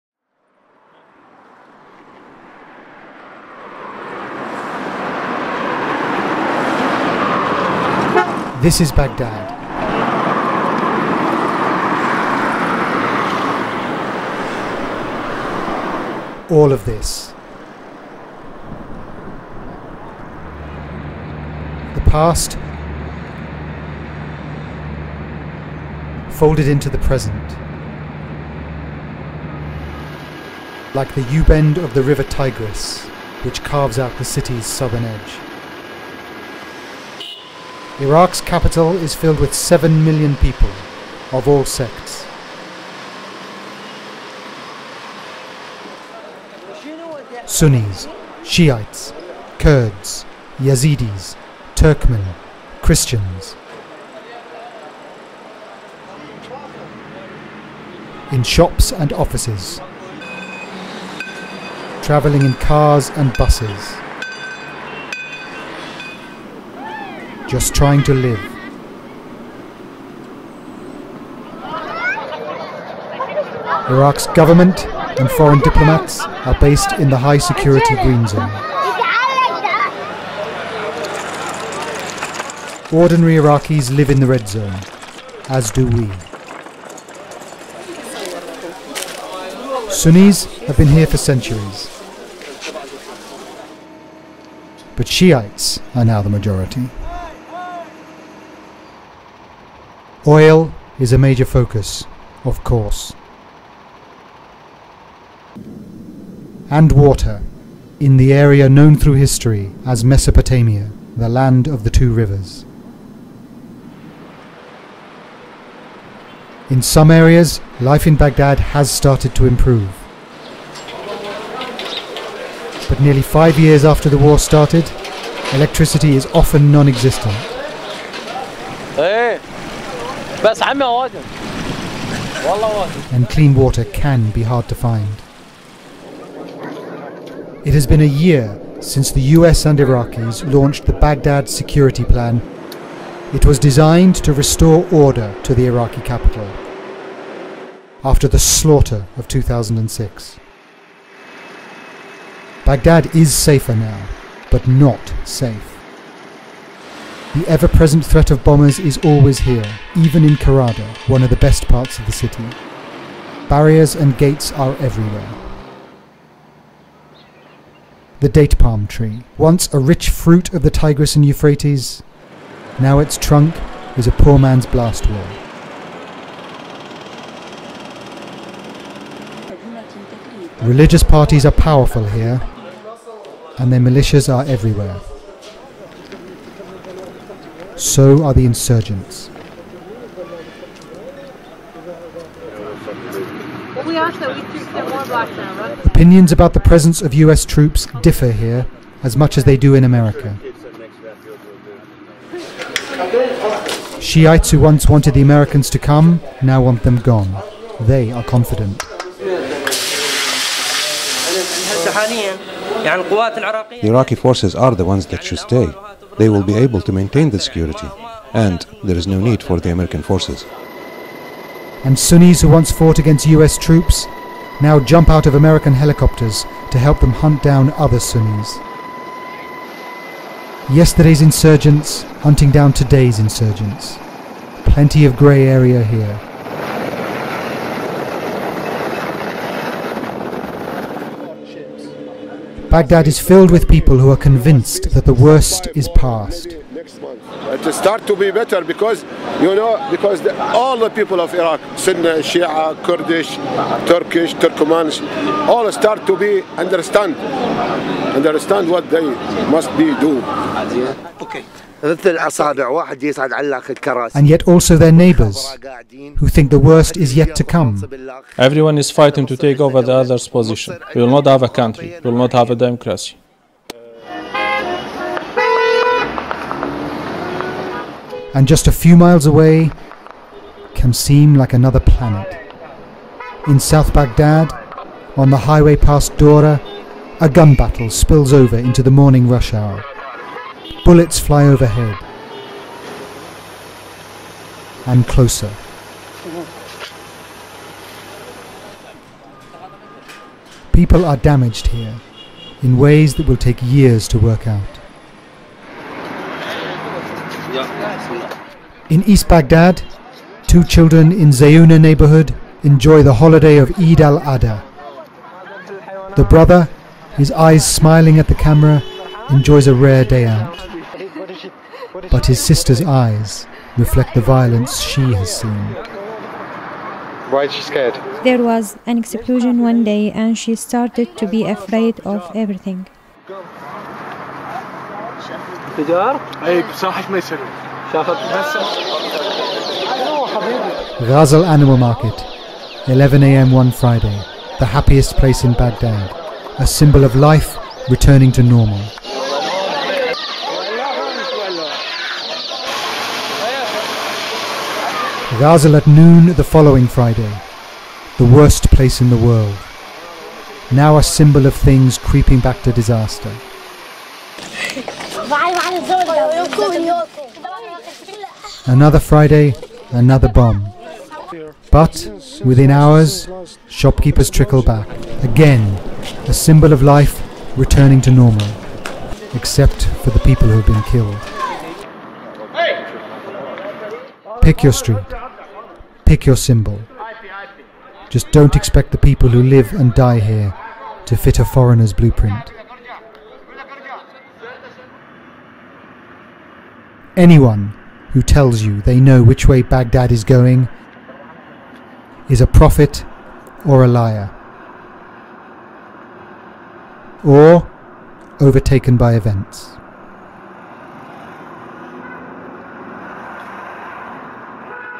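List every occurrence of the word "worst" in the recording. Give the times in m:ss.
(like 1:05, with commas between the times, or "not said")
4:05, 4:26, 5:58.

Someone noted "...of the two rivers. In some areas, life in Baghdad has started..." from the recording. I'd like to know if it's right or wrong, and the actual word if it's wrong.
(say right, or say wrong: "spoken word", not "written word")
right.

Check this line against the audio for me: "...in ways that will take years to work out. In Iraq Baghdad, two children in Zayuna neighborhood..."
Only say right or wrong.
wrong.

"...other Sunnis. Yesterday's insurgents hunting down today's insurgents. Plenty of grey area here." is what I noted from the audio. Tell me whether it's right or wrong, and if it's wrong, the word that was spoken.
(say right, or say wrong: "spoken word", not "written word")
right.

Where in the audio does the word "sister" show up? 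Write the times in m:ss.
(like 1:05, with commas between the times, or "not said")
5:22.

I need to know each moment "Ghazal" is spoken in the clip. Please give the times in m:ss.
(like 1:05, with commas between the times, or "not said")
5:41, 5:55.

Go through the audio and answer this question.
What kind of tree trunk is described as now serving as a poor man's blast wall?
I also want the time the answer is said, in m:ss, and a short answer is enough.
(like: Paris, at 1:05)
Date palm, at 2:48.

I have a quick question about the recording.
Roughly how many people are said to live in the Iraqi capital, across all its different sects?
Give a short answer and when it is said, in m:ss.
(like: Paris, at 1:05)
7 million, at 0:39.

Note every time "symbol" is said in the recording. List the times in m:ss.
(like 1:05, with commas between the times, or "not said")
5:46, 6:01, 6:16, 6:26.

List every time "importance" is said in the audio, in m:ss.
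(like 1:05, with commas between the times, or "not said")
not said.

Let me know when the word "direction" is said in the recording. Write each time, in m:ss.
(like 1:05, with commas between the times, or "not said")
not said.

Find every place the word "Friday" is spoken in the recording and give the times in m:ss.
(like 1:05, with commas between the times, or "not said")
5:43, 5:56, 6:08.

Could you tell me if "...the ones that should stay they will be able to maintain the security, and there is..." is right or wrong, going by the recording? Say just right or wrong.
right.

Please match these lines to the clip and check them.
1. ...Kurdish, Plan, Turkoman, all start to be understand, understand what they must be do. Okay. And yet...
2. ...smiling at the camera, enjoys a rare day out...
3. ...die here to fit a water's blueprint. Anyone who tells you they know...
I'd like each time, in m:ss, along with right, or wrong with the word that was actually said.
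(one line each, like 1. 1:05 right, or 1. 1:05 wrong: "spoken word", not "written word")
1. 4:12 wrong: "Turkish", not "Plan"
2. 5:17 right
3. 6:29 wrong: "foreigner", not "water".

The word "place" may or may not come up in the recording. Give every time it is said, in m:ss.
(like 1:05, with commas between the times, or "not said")
5:45, 5:58.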